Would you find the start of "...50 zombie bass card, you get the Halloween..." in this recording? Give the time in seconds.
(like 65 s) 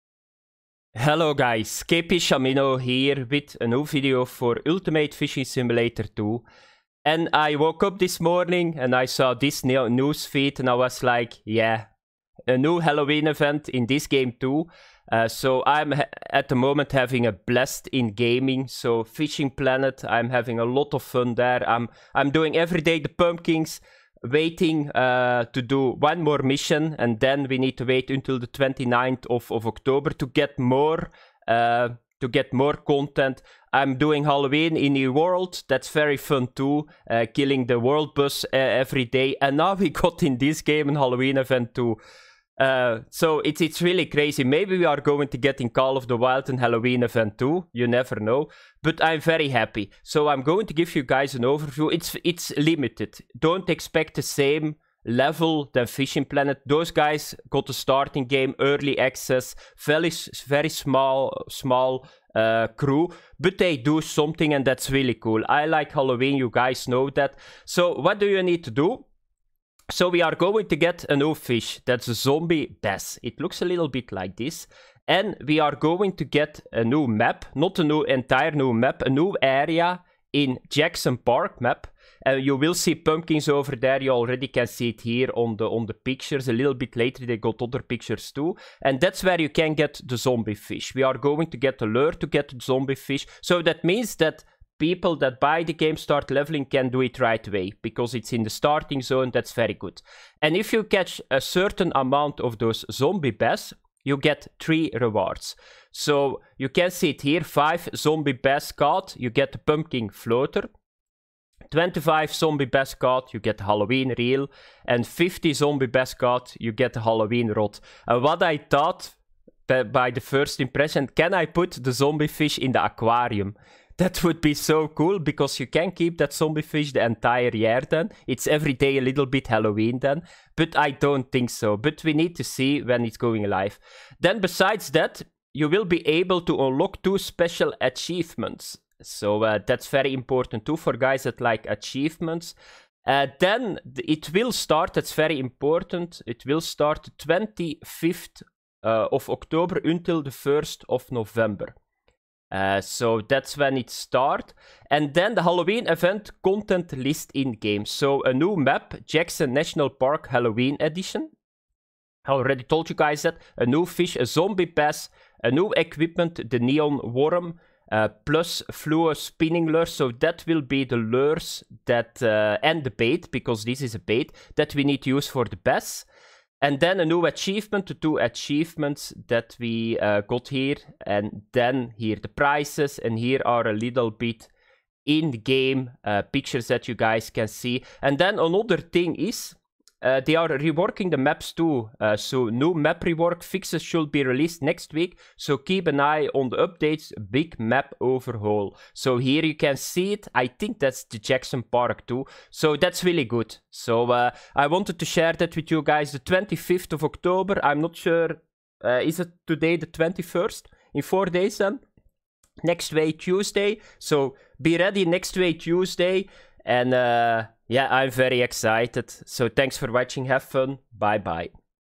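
115 s.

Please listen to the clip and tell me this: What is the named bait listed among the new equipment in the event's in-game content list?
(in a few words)
Neon worm.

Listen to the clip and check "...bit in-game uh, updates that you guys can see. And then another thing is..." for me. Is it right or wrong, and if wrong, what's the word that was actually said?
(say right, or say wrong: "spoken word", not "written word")
wrong: "pictures", not "updates".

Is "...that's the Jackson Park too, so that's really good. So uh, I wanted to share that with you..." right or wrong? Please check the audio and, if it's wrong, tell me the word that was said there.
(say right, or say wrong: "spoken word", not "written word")
right.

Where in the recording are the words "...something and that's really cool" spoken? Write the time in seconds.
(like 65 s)
64 s.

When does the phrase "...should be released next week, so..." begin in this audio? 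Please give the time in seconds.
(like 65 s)
193 s.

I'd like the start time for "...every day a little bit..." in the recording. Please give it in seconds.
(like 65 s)
128 s.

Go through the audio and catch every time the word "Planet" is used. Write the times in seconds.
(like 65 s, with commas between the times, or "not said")
19 s, 56 s.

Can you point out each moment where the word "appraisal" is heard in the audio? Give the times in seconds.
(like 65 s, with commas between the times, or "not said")
not said.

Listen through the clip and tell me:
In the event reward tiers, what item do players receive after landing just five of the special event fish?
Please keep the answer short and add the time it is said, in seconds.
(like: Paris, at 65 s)
Pumpkin floater, at 109 s.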